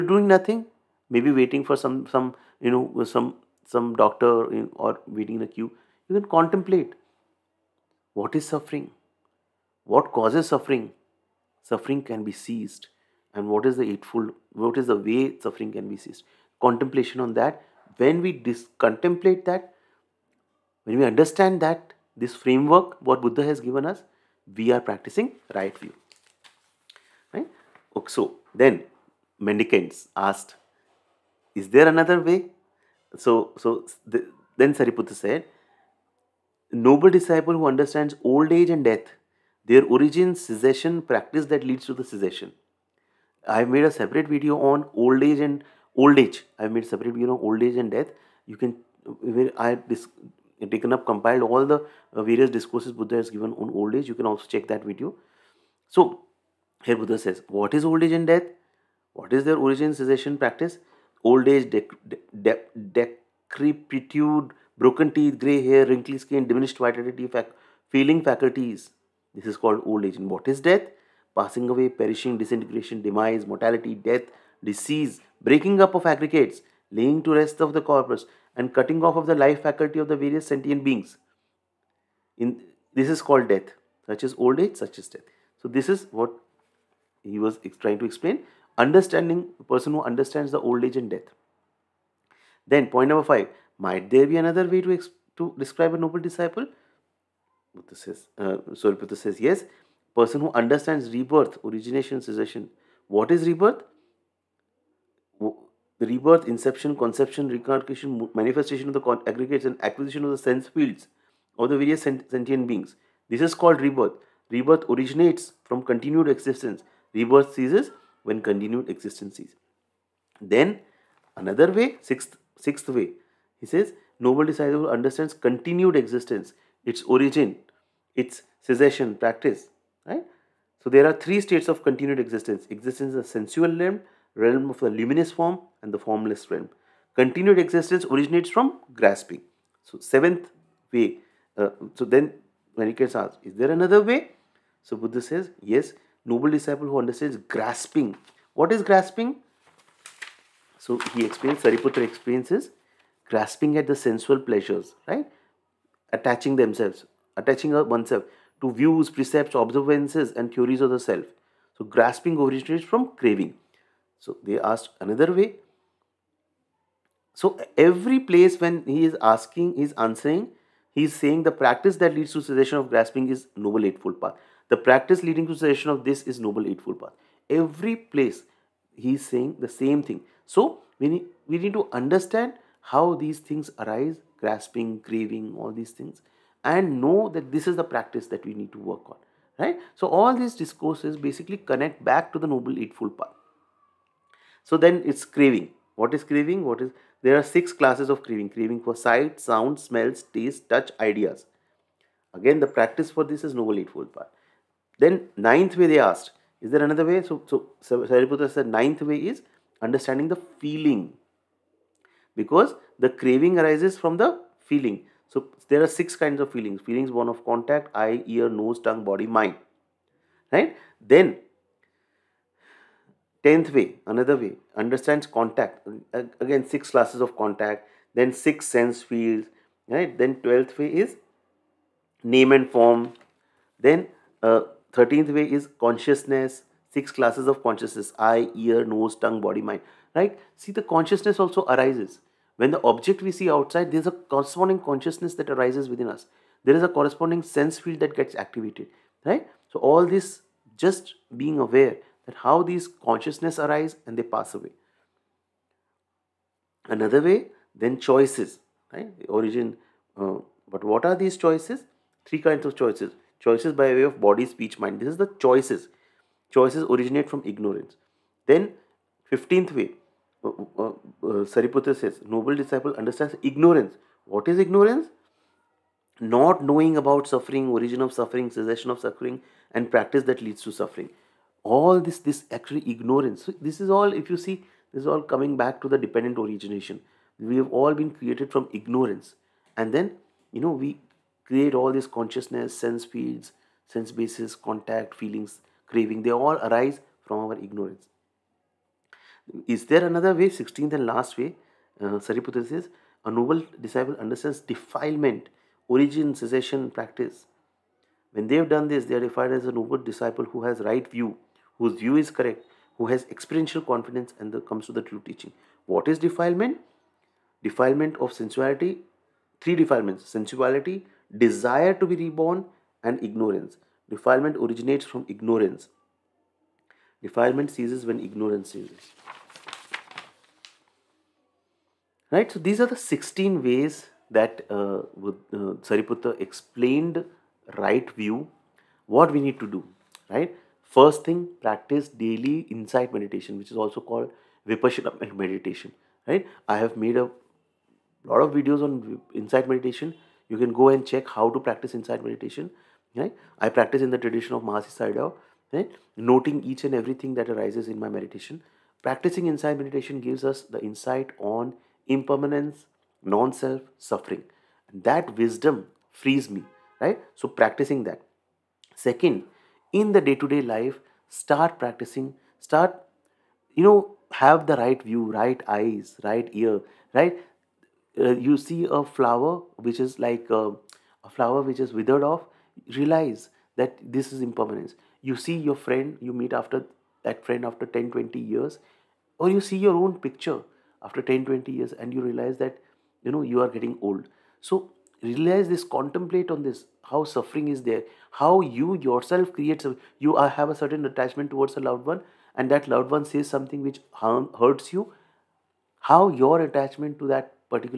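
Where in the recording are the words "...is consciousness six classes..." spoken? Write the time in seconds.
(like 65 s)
235 s.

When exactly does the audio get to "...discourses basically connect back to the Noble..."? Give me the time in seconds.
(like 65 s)
190 s.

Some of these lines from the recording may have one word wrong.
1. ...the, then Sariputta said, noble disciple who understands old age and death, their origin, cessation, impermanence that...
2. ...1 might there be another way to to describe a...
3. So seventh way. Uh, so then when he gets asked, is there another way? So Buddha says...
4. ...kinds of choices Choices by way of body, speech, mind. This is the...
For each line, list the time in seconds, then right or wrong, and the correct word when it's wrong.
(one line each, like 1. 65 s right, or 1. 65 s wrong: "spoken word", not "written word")
1. 34 s wrong: "practice", not "impermanence"
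2. 93 s wrong: "5", not "1"
3. 139 s right
4. 262 s right.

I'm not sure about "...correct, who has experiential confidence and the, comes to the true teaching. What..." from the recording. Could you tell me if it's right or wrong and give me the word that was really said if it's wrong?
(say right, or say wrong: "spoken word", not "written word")
right.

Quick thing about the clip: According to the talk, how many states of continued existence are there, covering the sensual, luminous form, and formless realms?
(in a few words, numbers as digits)
3.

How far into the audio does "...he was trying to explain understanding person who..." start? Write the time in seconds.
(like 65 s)
87 s.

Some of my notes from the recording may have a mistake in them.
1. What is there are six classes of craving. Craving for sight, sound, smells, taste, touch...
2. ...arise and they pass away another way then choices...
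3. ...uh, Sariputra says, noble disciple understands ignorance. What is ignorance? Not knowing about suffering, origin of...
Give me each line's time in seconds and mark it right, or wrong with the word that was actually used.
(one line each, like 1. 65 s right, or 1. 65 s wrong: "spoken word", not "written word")
1. 196 s right
2. 253 s right
3. 270 s right.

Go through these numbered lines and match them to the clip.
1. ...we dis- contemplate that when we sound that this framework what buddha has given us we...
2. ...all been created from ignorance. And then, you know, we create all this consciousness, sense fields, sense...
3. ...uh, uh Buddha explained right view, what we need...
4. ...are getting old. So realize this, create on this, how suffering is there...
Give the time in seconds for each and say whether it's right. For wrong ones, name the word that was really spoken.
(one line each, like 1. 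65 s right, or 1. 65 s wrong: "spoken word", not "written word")
1. 18 s wrong: "understand", not "sound"
2. 287 s right
3. 334 s wrong: "Sariputta", not "Buddha"
4. 393 s wrong: "contemplate", not "create".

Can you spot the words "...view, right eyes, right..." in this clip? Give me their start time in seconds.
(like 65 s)
375 s.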